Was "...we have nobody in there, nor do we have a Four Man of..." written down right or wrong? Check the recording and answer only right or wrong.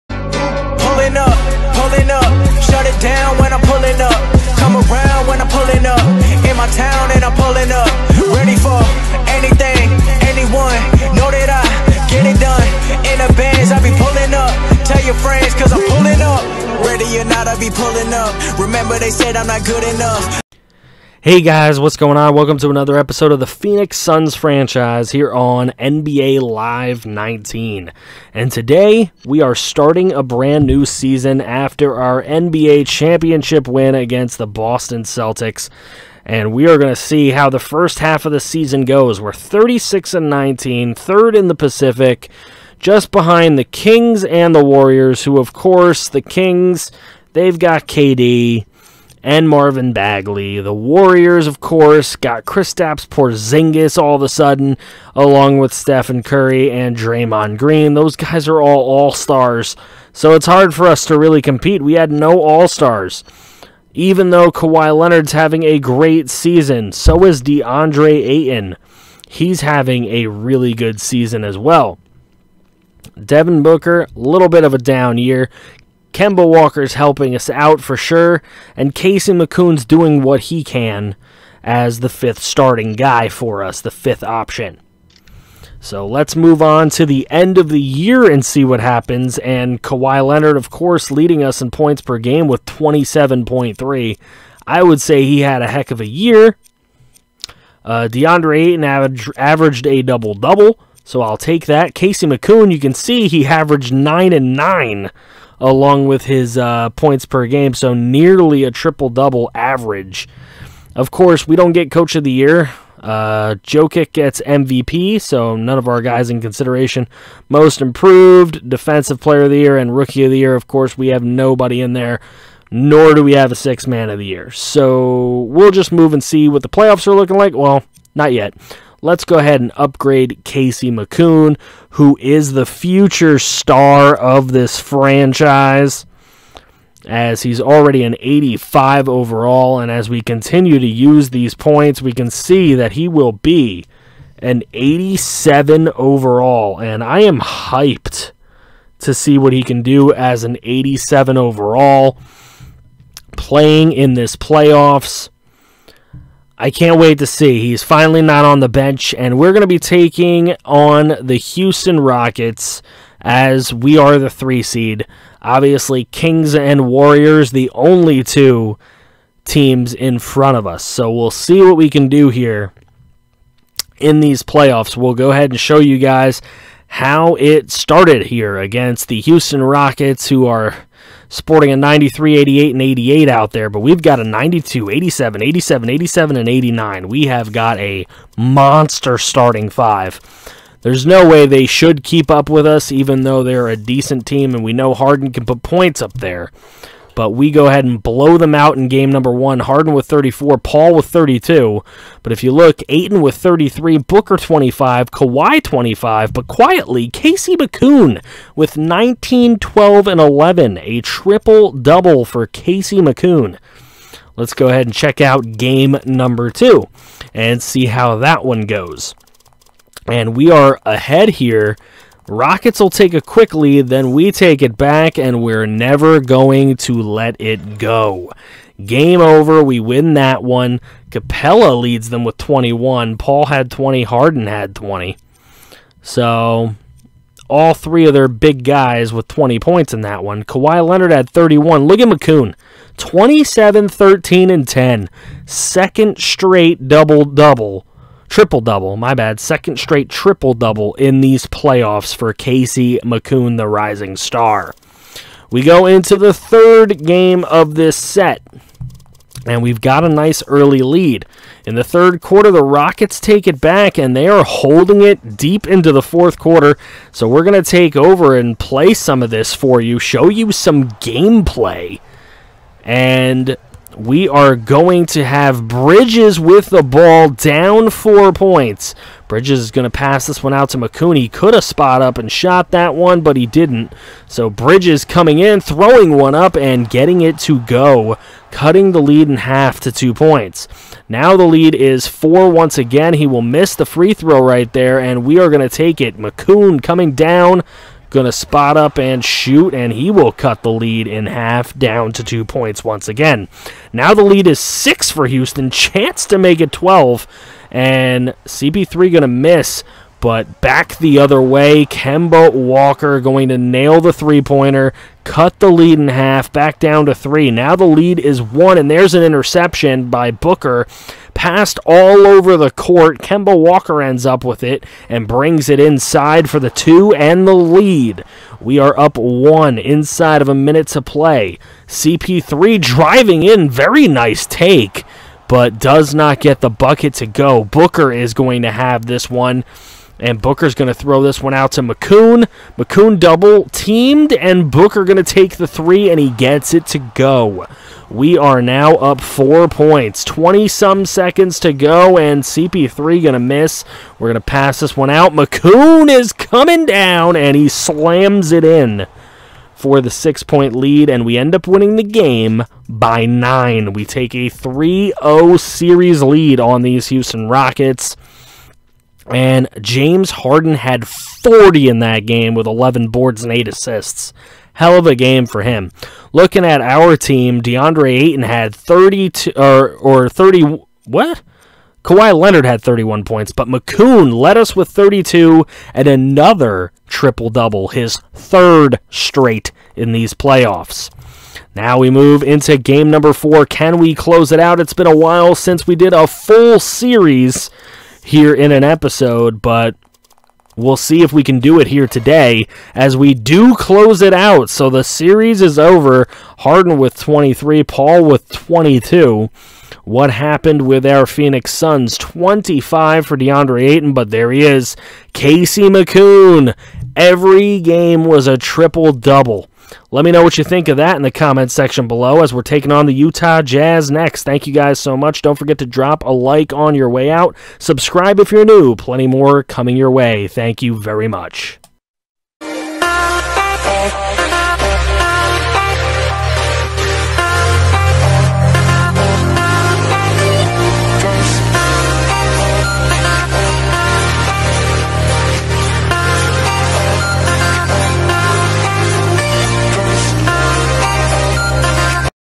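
wrong.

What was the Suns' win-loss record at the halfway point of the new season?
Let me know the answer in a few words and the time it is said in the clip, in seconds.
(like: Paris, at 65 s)
36 and 19, at 39 s.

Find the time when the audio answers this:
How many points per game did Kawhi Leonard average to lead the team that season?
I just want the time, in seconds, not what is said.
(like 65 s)
92 s.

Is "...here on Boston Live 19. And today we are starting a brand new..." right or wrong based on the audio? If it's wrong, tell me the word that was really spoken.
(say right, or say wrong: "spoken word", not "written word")
wrong: "NBA", not "Boston".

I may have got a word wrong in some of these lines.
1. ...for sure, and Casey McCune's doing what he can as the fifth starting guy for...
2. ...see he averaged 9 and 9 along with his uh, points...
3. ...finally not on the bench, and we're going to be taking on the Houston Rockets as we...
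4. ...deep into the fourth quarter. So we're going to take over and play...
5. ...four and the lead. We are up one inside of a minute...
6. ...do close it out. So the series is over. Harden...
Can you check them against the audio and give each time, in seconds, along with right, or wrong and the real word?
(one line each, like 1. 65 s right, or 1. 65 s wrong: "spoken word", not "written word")
1. 77 s right
2. 102 s right
3. 157 s right
4. 265 s right
5. 326 s wrong: "two", not "four"
6. 403 s right.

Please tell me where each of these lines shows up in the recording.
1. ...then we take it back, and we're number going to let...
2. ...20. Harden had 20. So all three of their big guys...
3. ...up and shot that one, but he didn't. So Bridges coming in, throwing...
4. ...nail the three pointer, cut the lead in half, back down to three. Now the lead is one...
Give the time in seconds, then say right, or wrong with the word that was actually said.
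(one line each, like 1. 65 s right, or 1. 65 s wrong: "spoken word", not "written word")
1. 223 s wrong: "never", not "number"
2. 233 s right
3. 282 s right
4. 313 s right.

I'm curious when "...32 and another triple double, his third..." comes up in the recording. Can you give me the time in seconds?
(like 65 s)
384 s.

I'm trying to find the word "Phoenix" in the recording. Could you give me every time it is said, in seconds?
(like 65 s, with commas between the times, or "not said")
23 s, 411 s.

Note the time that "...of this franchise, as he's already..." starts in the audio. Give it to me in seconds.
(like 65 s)
134 s.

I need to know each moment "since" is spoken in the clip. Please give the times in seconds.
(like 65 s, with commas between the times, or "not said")
395 s.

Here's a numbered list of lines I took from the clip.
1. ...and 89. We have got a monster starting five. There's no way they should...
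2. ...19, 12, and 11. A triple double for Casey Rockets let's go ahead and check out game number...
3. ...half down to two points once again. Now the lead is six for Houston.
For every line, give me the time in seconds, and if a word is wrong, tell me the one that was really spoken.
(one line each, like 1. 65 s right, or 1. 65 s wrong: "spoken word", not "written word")
1. 186 s right
2. 208 s wrong: "McCune", not "Rockets"
3. 301 s right.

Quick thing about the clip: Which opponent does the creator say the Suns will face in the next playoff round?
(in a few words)
Utah Jazz.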